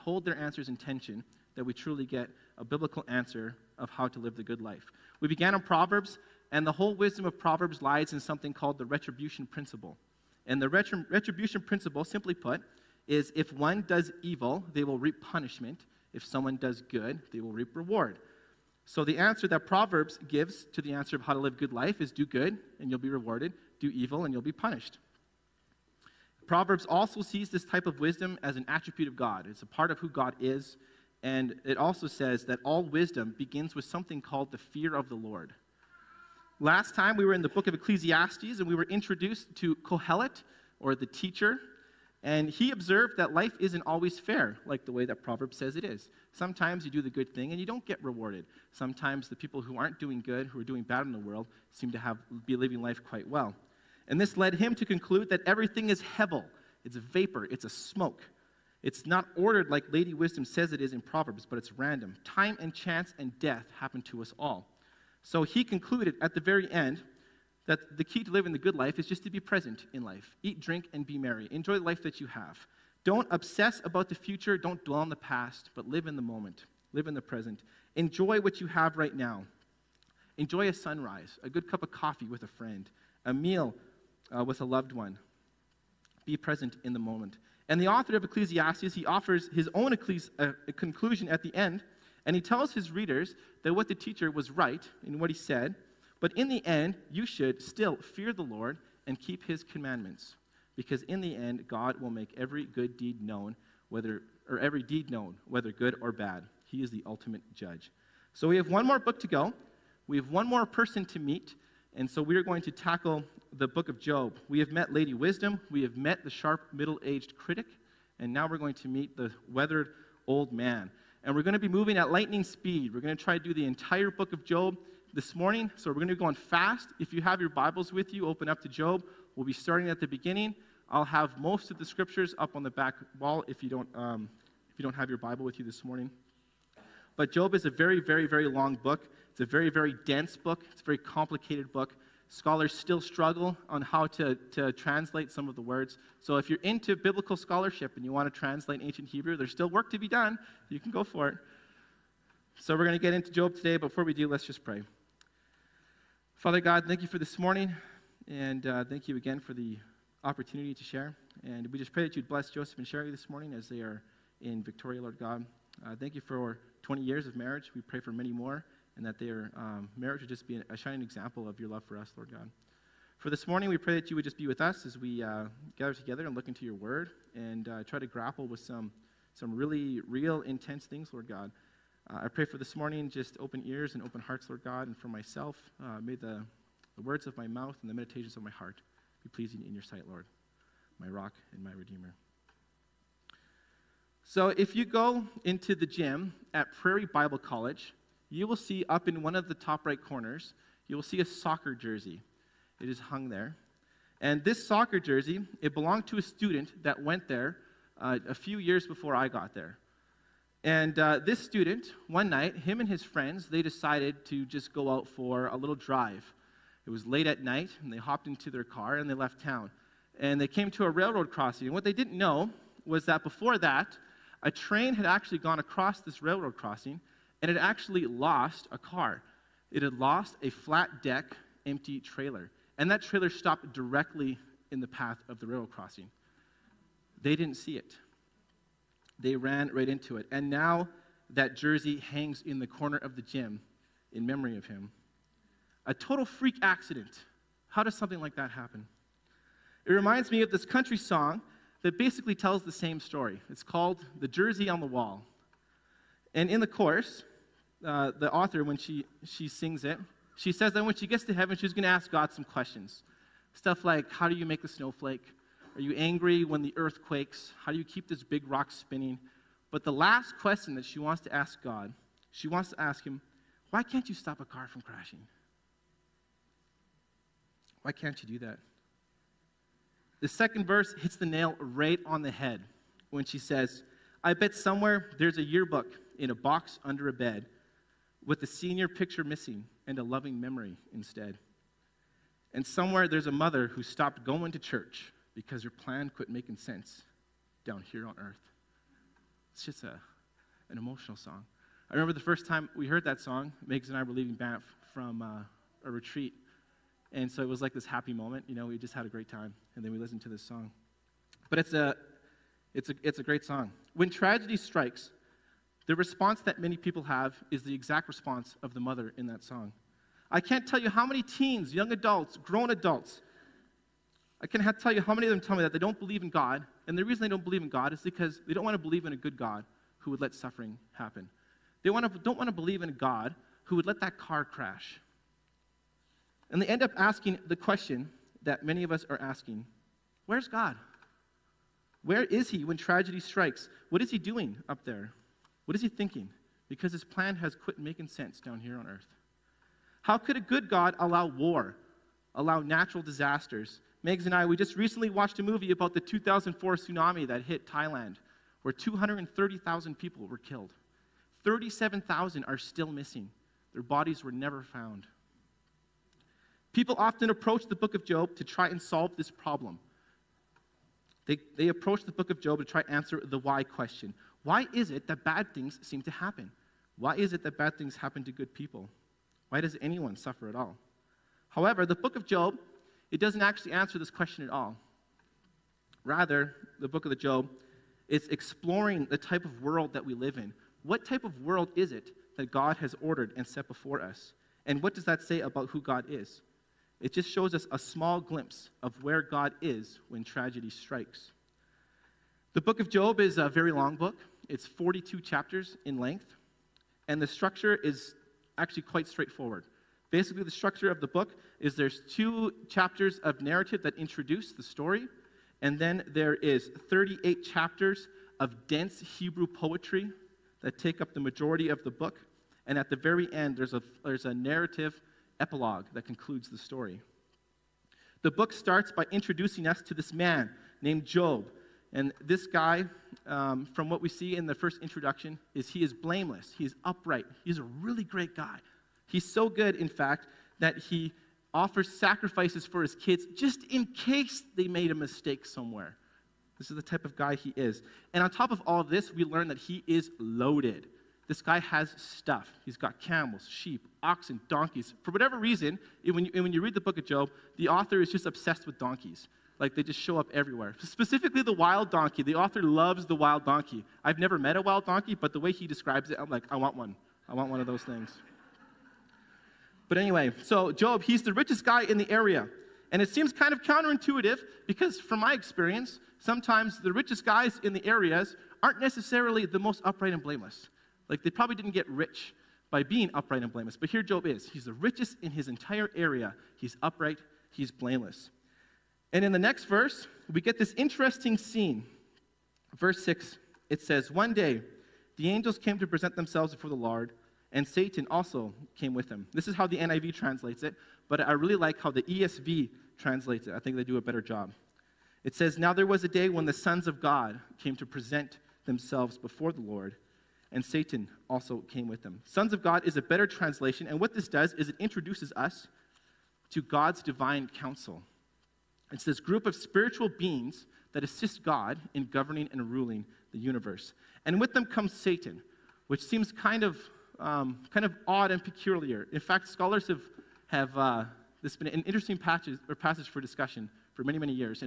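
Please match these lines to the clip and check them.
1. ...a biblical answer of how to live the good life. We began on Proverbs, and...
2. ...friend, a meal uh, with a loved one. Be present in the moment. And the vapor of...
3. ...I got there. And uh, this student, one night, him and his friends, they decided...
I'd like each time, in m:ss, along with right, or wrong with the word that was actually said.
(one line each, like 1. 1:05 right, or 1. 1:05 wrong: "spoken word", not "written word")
1. 0:02 right
2. 1:22 wrong: "author", not "vapor"
3. 3:29 right.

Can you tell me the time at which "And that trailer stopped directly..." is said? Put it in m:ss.
3:52.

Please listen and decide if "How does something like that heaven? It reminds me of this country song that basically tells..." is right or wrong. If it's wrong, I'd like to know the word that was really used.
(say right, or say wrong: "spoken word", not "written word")
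wrong: "happen", not "heaven".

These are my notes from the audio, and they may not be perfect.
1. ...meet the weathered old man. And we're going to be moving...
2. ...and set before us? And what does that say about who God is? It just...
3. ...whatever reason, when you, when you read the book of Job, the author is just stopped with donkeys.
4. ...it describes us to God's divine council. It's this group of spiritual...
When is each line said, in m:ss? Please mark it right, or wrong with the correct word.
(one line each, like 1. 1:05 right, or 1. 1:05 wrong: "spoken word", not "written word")
1. 1:58 right
2. 6:33 right
3. 7:35 wrong: "obsessed", not "stopped"
4. 8:34 wrong: "introduces", not "describes".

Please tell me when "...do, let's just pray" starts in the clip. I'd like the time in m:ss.
2:34.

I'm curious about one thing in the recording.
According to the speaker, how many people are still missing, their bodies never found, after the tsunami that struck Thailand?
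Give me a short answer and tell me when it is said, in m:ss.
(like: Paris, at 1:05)
37,000, at 6:01.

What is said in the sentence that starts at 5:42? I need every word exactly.
Where is He when tragedy strikes?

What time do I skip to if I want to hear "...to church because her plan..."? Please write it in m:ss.
4:54.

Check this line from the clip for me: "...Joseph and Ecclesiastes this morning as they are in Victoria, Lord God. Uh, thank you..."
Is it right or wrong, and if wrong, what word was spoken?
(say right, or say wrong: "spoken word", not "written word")
wrong: "Sherry", not "Ecclesiastes".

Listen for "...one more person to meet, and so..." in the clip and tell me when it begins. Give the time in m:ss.
1:50.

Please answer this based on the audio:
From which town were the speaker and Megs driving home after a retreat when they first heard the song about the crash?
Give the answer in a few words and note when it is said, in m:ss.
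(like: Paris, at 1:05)
Banff, at 5:04.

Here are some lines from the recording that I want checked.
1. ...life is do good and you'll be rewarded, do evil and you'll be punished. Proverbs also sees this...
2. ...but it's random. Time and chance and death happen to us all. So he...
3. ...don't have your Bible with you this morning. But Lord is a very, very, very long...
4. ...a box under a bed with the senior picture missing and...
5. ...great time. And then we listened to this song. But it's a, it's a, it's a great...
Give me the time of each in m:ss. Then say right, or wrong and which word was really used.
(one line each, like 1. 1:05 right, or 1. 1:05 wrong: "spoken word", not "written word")
1. 0:21 right
2. 1:01 right
3. 2:14 wrong: "Job", not "Lord"
4. 4:46 right
5. 5:09 right.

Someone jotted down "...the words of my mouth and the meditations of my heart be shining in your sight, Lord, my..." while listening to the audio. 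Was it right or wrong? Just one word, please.
wrong.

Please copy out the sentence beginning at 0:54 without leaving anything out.
And this led him to conclude that everything is hevel.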